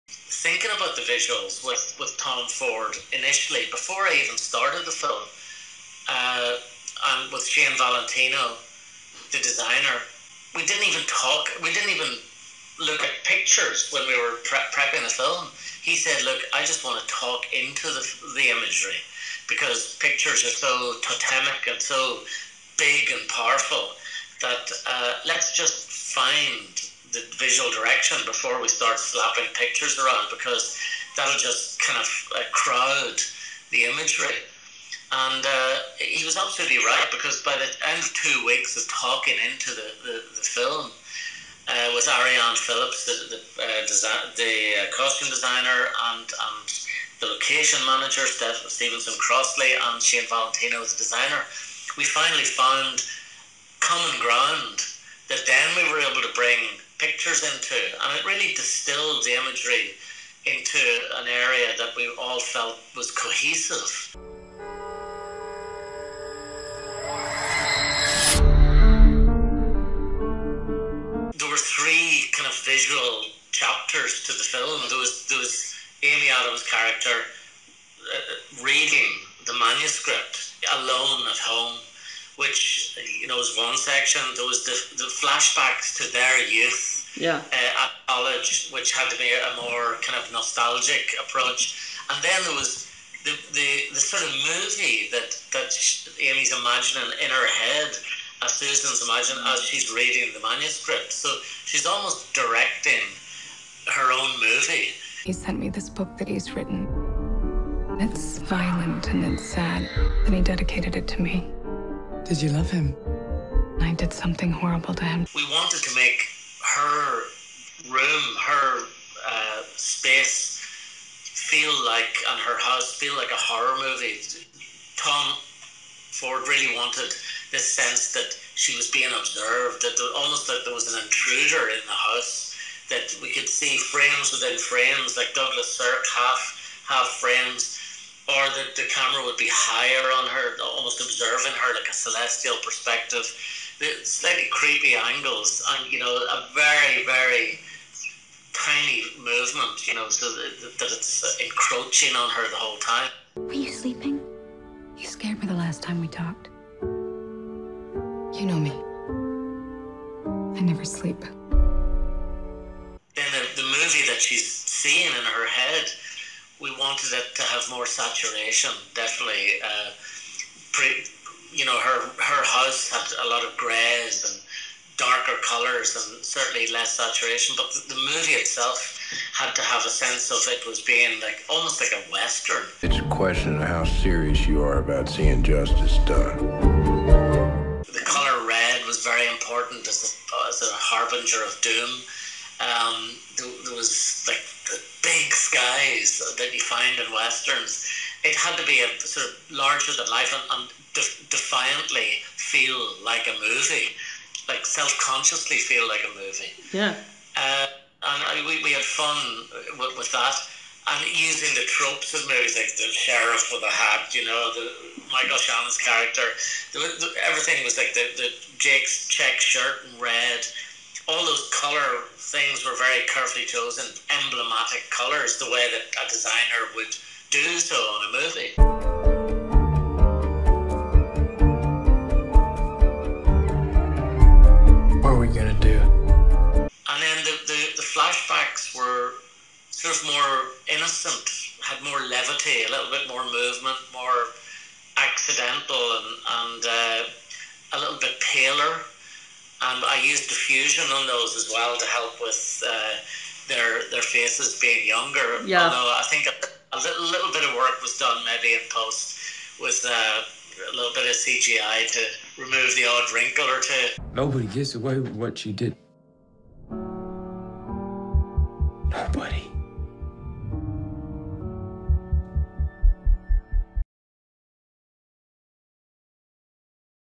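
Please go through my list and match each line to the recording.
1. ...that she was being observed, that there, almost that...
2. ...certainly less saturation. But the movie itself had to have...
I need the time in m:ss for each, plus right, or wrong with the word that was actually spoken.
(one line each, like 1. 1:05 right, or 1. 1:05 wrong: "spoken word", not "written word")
1. 2:08 right
2. 2:56 right.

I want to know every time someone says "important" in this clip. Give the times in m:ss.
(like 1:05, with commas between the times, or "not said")
3:09.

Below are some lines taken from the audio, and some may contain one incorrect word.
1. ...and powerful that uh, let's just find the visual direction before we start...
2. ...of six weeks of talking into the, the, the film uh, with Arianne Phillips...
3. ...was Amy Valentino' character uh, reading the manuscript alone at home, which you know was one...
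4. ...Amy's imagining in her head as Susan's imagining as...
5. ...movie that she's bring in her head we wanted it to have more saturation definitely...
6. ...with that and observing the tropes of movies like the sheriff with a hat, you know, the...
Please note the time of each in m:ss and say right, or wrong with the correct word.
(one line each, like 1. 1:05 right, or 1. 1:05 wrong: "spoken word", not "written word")
1. 0:23 right
2. 0:37 wrong: "two", not "six"
3. 1:15 wrong: "Adams", not "Valentino"
4. 1:36 right
5. 2:43 wrong: "seeing", not "bring"
6. 3:29 wrong: "using", not "observing".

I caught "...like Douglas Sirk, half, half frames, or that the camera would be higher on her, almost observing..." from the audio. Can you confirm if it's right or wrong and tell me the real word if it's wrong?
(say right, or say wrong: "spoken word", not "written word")
right.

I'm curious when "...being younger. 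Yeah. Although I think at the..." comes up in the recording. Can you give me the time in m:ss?
4:14.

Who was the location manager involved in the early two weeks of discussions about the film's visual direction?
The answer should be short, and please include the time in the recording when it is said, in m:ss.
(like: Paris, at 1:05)
Stevenson Crossley, at 0:48.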